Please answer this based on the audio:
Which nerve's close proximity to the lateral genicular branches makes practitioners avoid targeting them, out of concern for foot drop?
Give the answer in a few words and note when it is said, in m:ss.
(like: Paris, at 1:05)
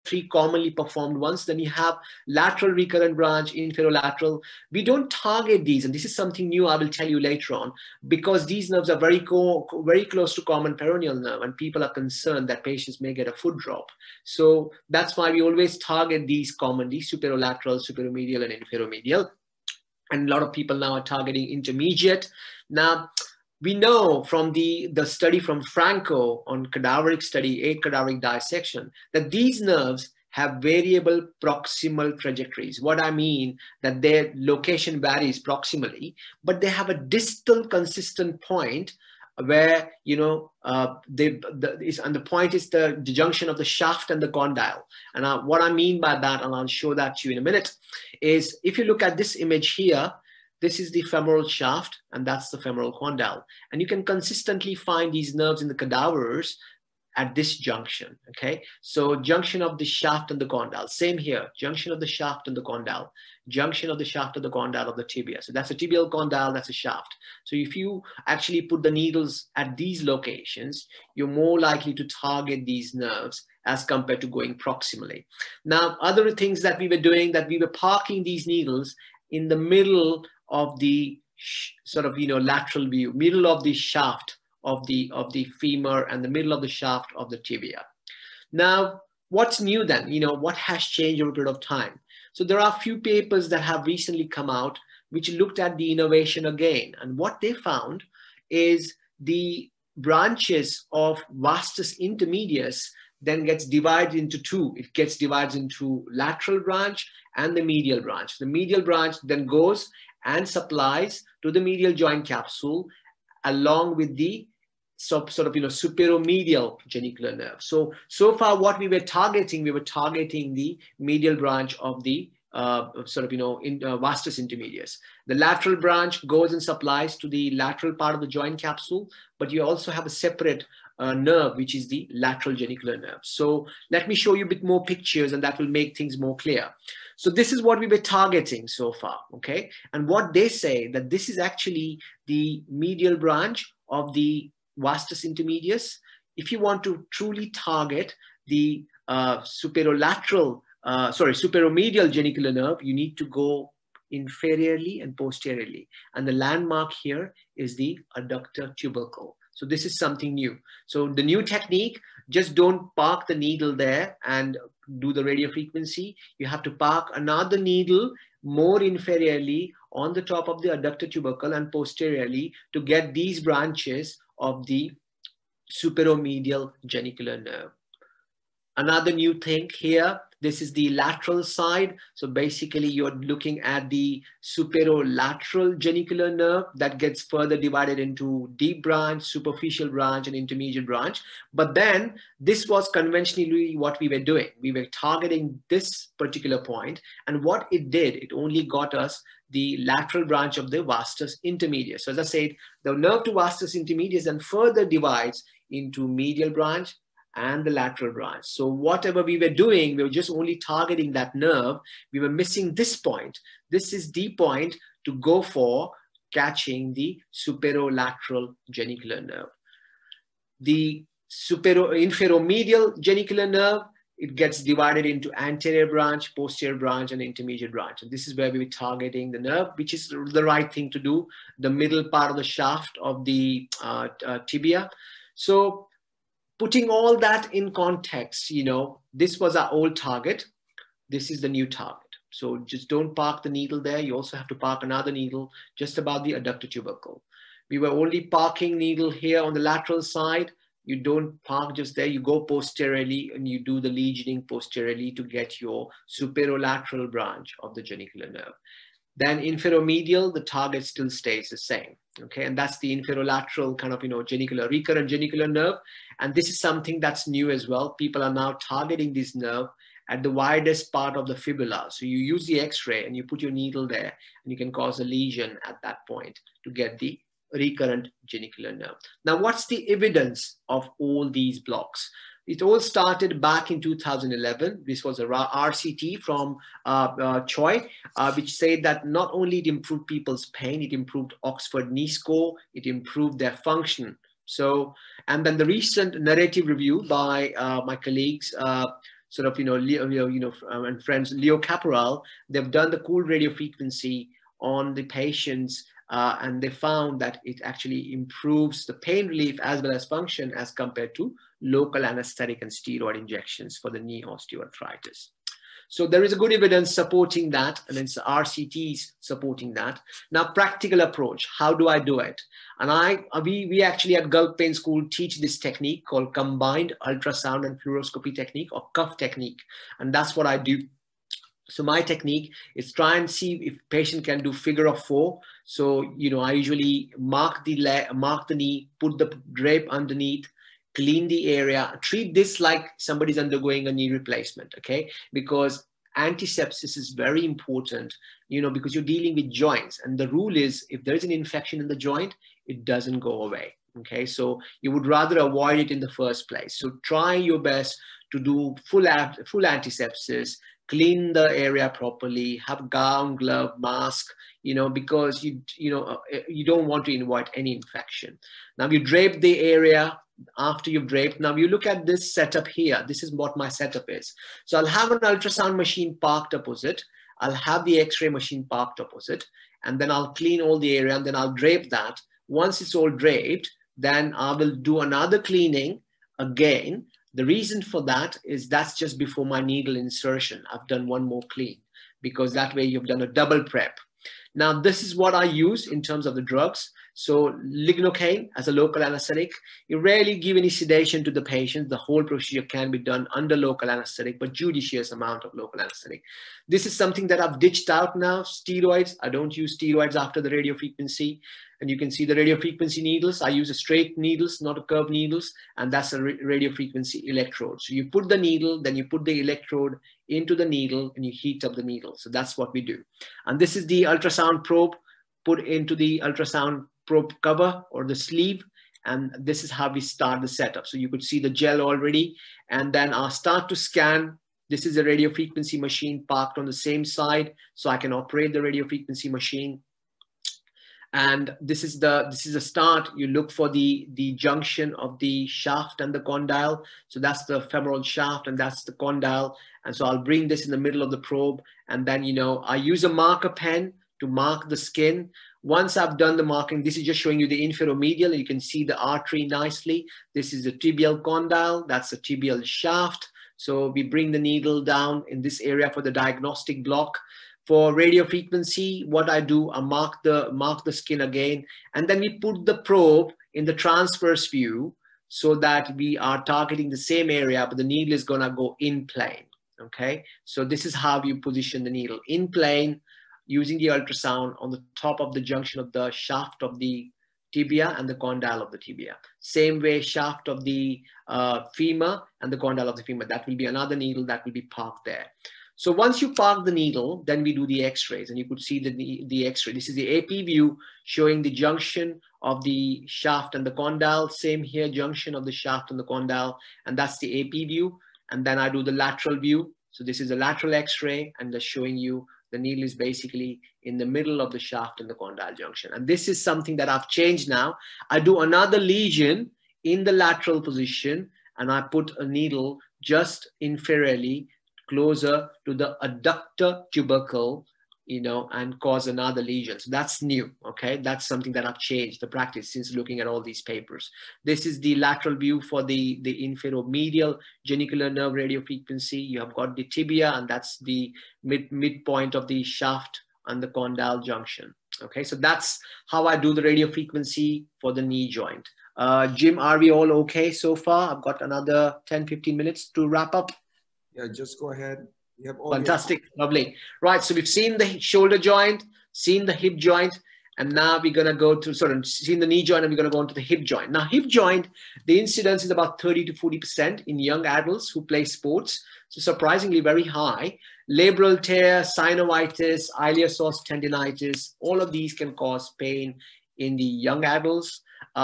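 Common peroneal nerve, at 0:10.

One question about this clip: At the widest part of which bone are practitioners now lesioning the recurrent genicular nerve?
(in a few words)
Fibula.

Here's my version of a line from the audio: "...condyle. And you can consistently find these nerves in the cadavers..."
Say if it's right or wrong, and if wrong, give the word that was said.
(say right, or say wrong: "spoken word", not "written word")
right.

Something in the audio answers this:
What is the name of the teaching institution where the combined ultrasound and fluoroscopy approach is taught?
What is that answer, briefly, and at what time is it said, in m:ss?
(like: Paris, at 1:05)
Gulf Pain School, at 5:24.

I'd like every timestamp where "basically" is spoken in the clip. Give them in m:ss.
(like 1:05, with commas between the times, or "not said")
3:02, 8:32.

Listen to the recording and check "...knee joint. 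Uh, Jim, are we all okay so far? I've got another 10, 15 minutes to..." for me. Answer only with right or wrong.
right.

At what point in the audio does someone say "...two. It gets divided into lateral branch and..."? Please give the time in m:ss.
1:44.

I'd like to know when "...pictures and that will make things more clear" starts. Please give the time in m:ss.
2:14.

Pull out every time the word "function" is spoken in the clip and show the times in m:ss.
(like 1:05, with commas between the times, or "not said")
4:53, 5:10.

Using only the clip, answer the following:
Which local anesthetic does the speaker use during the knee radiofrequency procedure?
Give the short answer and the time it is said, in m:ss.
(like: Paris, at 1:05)
Lignocaine, at 6:37.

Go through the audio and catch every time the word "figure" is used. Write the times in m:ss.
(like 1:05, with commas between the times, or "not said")
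5:34.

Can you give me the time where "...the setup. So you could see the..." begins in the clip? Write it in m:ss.
7:10.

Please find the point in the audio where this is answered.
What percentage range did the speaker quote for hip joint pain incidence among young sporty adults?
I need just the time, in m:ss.
9:26.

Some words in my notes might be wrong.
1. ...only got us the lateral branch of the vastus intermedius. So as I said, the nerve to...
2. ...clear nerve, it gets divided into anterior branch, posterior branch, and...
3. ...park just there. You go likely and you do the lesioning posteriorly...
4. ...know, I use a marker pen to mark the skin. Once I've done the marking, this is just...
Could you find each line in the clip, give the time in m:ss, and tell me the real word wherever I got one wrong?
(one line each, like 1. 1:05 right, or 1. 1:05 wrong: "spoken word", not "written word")
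1. 3:18 right
2. 3:42 wrong: "genicular", not "clear"
3. 4:11 wrong: "posteriorly", not "likely"
4. 7:32 right.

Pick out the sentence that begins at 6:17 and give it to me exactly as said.
I'll have the x-ray machine parked opposite and then I'll clean all the area and then I'll drape that.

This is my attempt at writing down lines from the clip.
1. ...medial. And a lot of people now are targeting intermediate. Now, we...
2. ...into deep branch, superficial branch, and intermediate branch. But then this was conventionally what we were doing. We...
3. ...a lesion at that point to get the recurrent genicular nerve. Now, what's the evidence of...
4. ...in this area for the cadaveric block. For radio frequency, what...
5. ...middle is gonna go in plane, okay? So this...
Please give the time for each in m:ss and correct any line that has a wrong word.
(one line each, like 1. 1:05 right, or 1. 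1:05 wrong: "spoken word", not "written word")
1. 0:18 wrong: "inferomedial", not "medial"
2. 3:08 right
3. 4:35 right
4. 7:45 wrong: "diagnostic", not "cadaveric"
5. 7:57 wrong: "needle", not "middle".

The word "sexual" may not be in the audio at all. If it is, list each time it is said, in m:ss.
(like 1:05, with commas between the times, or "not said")
not said.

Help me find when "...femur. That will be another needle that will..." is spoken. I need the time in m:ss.
8:13.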